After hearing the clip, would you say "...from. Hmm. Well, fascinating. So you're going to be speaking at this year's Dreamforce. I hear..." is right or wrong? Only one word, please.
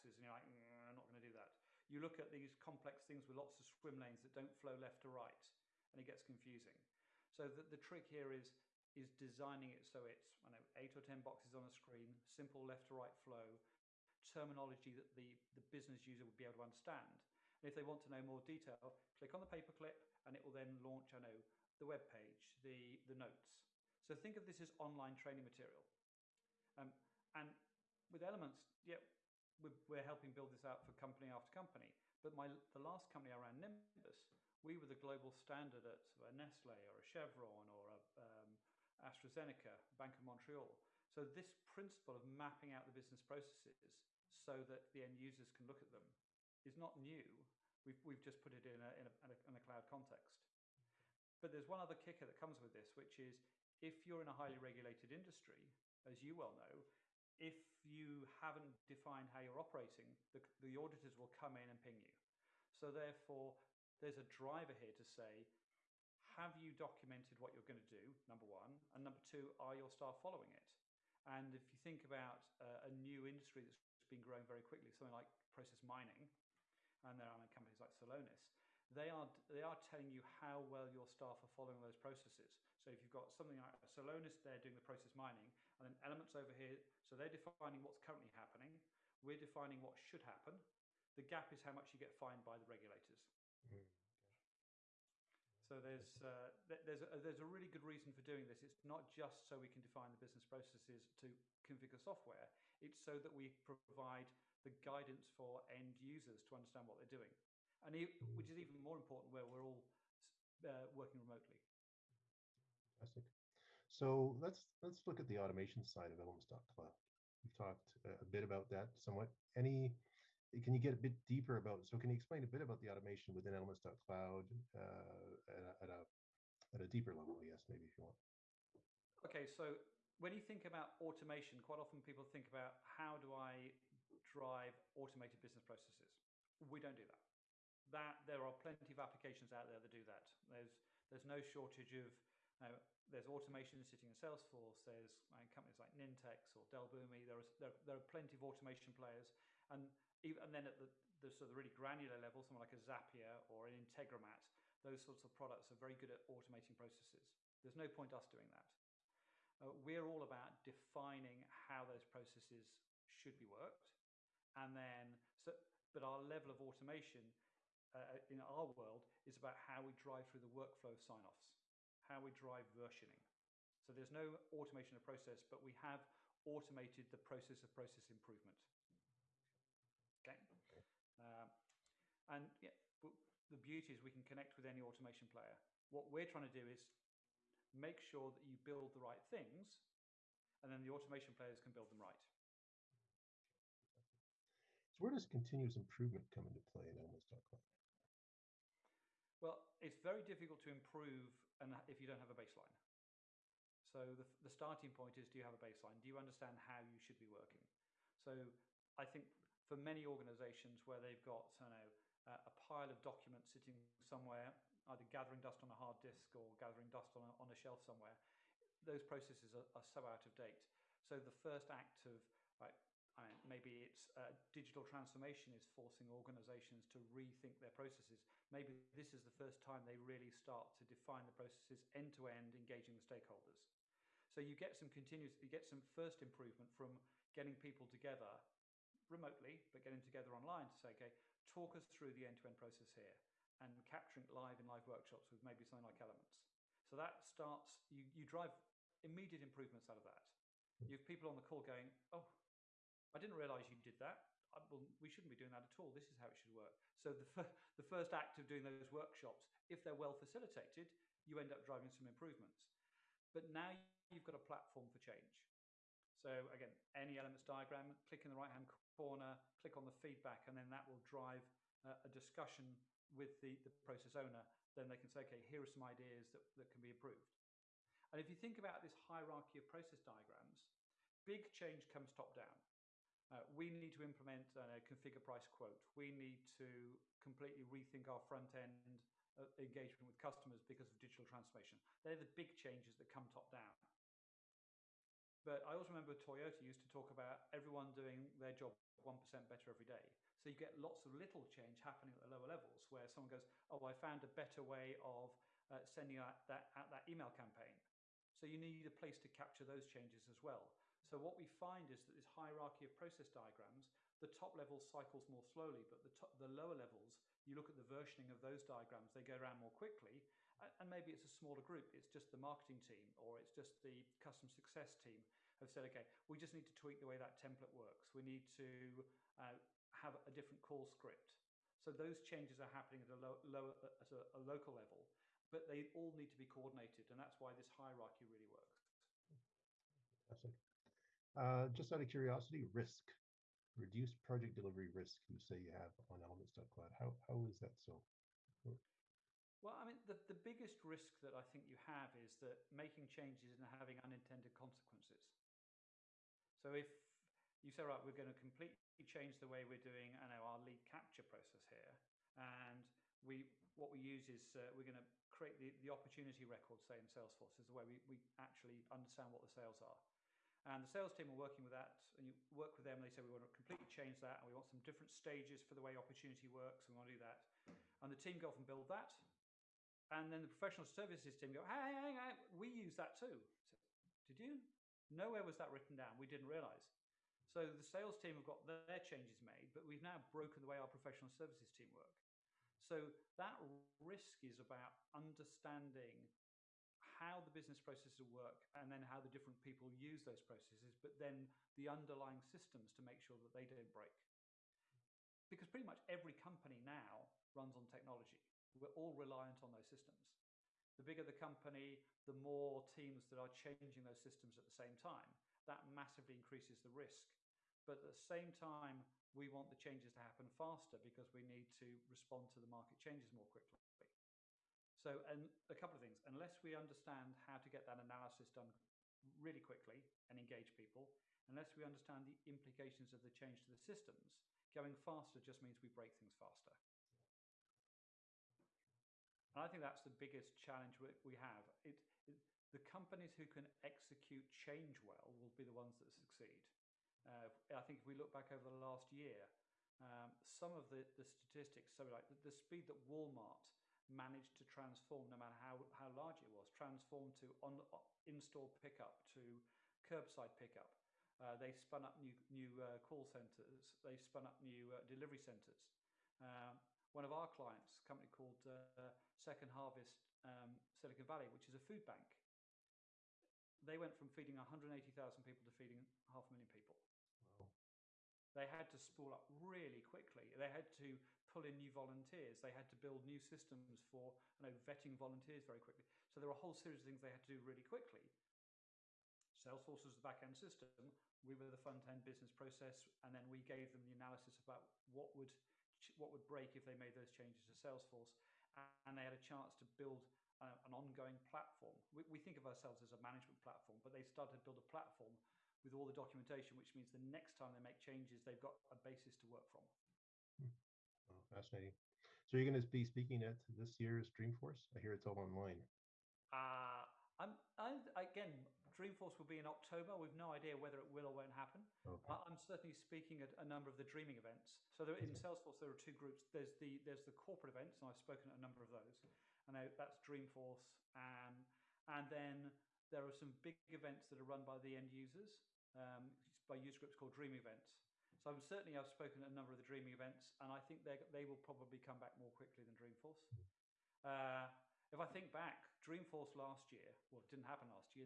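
right.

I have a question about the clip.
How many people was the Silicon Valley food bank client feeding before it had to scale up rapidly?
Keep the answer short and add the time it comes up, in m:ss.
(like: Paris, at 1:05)
180,000, at 7:54.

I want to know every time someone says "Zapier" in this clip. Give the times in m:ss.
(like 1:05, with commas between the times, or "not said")
2:32.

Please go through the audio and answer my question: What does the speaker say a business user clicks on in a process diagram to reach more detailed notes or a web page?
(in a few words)
the paperclip.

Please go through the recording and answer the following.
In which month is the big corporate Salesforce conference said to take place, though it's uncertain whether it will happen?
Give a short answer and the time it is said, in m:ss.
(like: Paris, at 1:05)
October, at 8:39.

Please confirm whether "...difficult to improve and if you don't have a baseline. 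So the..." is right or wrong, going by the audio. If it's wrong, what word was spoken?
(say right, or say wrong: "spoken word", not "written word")
right.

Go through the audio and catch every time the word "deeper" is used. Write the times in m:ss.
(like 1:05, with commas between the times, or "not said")
2:01, 2:06.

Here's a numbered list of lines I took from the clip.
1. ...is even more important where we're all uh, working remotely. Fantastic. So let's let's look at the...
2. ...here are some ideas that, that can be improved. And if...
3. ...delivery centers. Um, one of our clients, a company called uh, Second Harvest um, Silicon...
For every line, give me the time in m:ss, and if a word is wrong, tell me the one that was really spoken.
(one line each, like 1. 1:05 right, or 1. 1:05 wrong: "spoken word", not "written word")
1. 1:48 right
2. 4:35 right
3. 7:45 right.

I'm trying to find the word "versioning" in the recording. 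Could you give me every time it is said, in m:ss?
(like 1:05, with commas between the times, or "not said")
2:52, 5:17.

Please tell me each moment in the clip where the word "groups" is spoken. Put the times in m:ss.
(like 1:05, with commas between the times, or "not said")
5:21, 8:46, 8:56.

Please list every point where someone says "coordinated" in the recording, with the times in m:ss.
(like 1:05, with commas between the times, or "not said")
5:36.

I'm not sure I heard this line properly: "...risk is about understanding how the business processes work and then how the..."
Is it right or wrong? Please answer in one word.
right.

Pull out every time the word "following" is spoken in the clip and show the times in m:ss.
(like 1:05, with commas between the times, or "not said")
1:10, 1:21.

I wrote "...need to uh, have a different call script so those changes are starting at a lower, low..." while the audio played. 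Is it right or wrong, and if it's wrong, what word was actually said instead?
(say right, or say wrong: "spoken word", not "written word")
wrong: "happening", not "starting".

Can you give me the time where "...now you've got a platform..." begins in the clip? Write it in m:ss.
4:23.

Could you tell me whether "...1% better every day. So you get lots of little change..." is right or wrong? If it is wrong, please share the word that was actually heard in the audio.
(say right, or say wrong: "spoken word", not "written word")
right.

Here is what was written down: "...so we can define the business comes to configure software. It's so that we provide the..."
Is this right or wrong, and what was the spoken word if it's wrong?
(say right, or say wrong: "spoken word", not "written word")
wrong: "processes", not "comes".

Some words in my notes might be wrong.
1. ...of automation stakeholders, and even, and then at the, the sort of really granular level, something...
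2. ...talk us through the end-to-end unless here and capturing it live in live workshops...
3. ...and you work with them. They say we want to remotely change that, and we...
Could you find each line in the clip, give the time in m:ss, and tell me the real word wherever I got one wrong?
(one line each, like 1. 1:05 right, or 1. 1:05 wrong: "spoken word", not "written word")
1. 2:28 wrong: "players", not "stakeholders"
2. 4:01 wrong: "process", not "unless"
3. 6:12 wrong: "completely", not "remotely".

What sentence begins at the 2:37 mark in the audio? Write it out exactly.
There's no point us doing that.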